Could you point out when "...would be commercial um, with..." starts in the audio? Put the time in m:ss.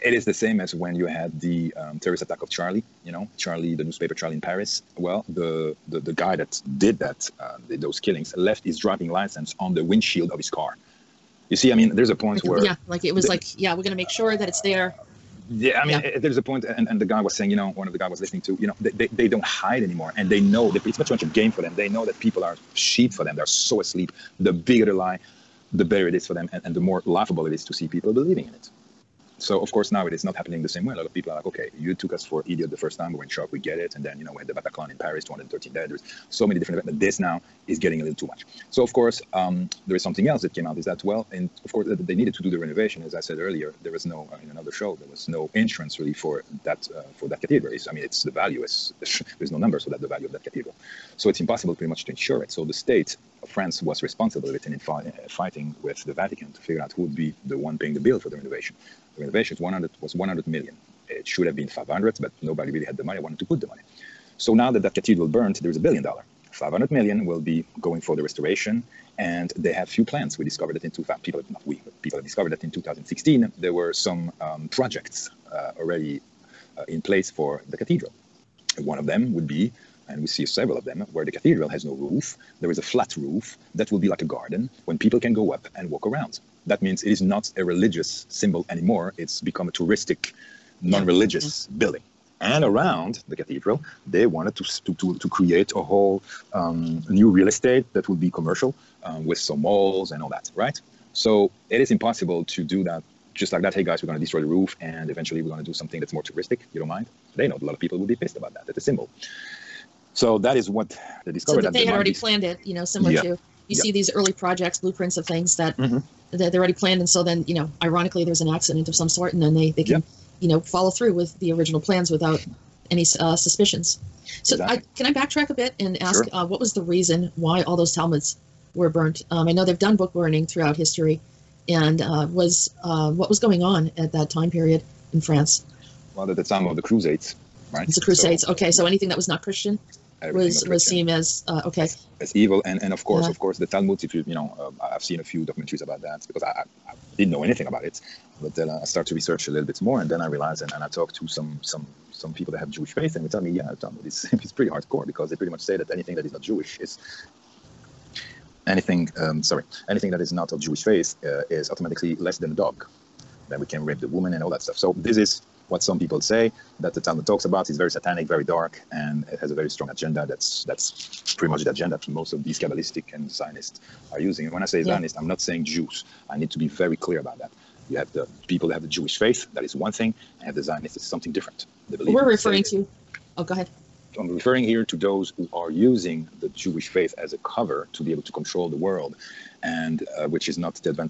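1:38.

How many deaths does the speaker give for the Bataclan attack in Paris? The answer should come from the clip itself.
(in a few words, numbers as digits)
213.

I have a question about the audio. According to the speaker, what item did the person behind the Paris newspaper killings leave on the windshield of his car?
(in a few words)
driving license.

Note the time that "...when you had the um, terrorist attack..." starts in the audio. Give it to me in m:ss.
0:00.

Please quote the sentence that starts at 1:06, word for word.
500 million will be going for the restoration, and they have few plans.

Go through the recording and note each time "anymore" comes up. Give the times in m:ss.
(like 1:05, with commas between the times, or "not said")
0:19, 1:28.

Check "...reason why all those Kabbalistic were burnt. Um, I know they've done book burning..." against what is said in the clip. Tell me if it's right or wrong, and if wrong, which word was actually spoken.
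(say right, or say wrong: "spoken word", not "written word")
wrong: "Talmuds", not "Kabbalistic".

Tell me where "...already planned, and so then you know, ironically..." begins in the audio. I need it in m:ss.
1:56.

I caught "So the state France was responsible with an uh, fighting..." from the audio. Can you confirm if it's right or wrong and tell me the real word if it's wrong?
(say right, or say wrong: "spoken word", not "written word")
right.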